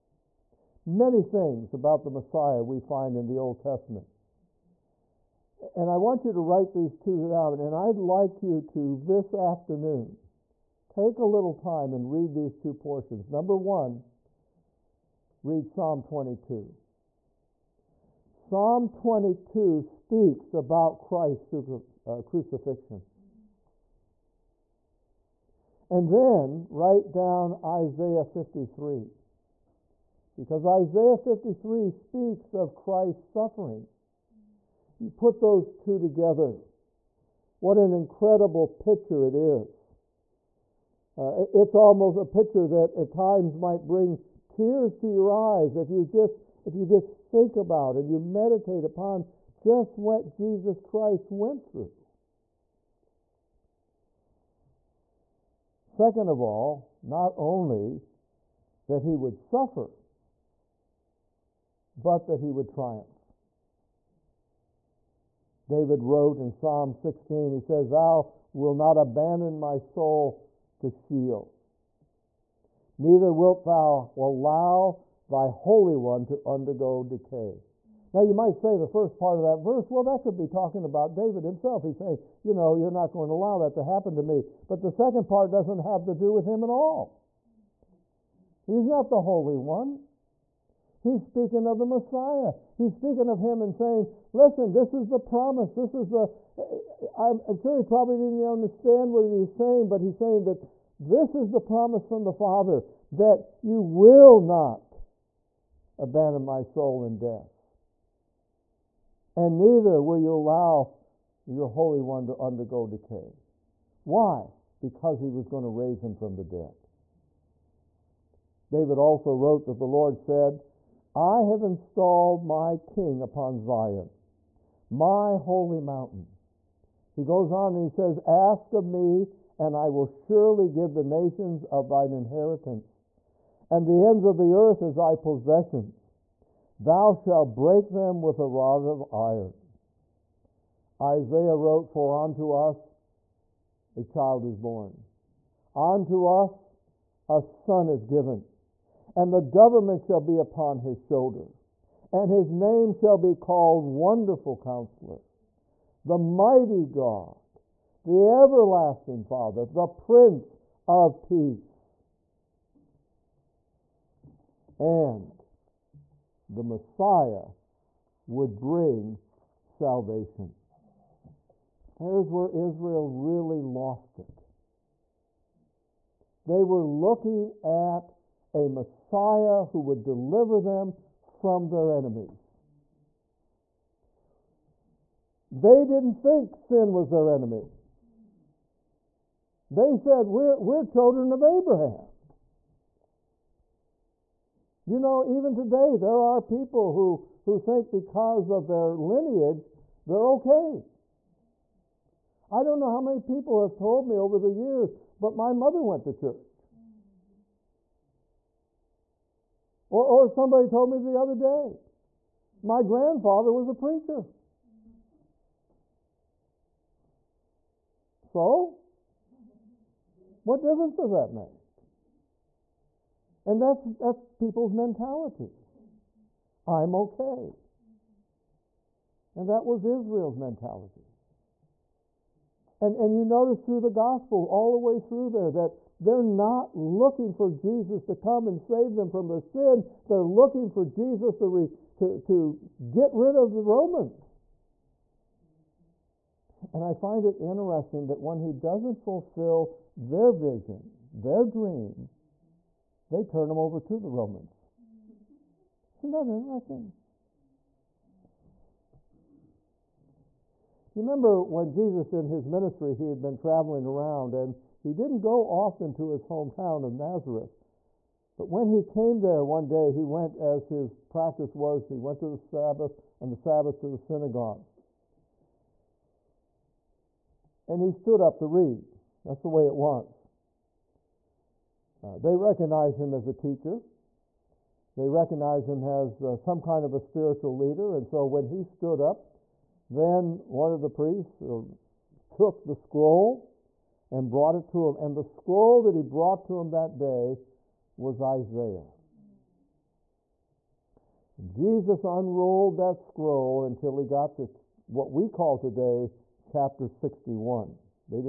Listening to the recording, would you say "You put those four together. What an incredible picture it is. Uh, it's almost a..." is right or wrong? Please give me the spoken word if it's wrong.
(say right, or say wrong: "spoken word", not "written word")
wrong: "two", not "four".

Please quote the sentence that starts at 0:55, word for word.
Second of all, not only that he would suffer, but that he would triumph.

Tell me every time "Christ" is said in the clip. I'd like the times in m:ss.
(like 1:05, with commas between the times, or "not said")
0:21, 0:32, 0:50.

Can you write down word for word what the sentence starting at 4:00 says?
They're looking for Jesus to, re, to, to get rid of the Romans.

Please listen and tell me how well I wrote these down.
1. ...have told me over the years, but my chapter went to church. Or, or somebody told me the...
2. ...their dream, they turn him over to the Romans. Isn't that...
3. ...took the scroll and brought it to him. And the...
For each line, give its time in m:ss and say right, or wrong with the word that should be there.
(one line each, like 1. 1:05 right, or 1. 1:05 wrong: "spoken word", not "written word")
1. 3:23 wrong: "mother", not "chapter"
2. 4:11 right
3. 4:52 right.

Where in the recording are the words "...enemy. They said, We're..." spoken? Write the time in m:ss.
3:07.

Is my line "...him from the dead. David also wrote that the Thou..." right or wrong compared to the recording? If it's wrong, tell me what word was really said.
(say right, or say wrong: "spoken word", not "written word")
wrong: "Lord", not "Thou".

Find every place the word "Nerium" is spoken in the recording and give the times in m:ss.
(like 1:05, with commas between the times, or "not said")
not said.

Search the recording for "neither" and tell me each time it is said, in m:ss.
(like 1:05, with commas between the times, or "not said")
1:12, 1:49.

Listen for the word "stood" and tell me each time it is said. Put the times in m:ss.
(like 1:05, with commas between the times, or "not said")
4:37, 4:48.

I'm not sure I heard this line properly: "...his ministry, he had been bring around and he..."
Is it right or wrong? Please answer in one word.
wrong.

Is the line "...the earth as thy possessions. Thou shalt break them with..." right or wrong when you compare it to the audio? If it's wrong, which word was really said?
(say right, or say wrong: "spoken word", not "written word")
right.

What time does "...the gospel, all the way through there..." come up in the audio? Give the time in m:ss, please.
3:53.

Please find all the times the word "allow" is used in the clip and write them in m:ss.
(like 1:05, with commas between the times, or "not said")
1:14, 1:23, 1:50.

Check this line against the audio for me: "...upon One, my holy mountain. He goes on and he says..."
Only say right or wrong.
wrong.